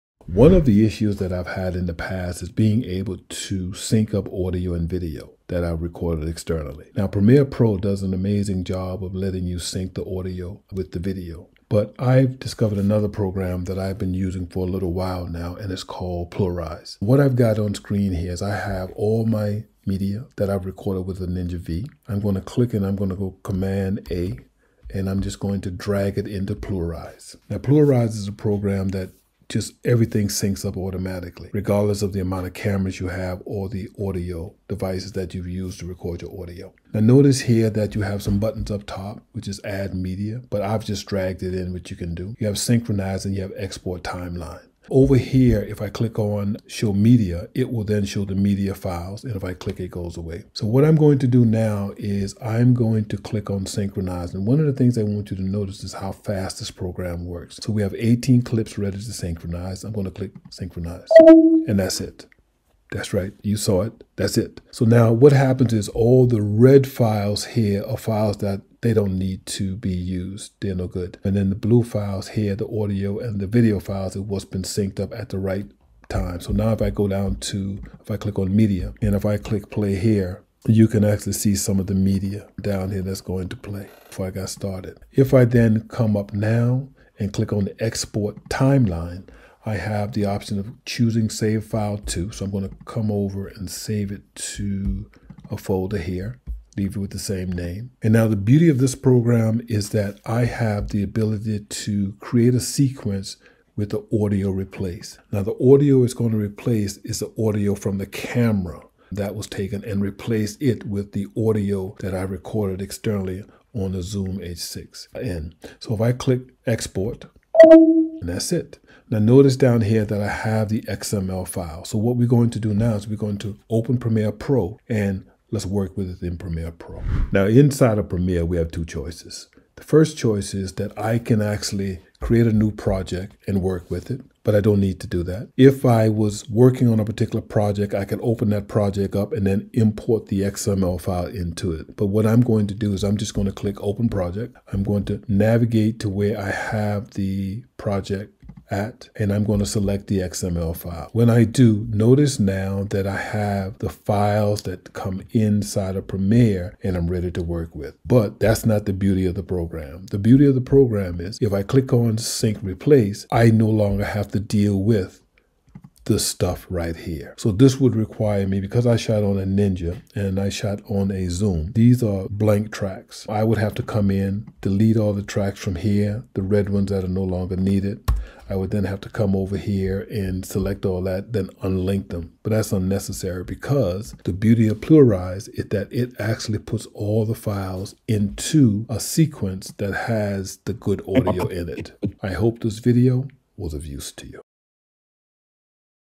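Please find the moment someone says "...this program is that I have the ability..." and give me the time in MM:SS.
01:38.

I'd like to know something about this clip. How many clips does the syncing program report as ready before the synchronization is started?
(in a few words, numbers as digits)
18.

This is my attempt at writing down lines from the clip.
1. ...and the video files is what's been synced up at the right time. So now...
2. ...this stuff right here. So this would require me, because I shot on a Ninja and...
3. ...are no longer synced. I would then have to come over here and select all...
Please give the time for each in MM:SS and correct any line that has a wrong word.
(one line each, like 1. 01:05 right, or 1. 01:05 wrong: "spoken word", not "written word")
1. 01:13 right
2. 02:46 right
3. 02:57 wrong: "needed", not "synced".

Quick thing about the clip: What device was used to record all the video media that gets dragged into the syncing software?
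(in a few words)
Ninja V.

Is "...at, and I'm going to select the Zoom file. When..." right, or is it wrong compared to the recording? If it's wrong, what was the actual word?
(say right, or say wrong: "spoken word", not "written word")
wrong: "XML", not "Zoom".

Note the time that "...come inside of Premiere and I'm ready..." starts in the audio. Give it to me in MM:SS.
02:34.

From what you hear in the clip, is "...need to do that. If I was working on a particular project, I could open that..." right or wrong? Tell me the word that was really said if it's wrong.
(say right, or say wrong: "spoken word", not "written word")
right.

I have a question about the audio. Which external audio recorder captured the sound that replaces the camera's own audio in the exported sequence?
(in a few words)
Zoom H6N.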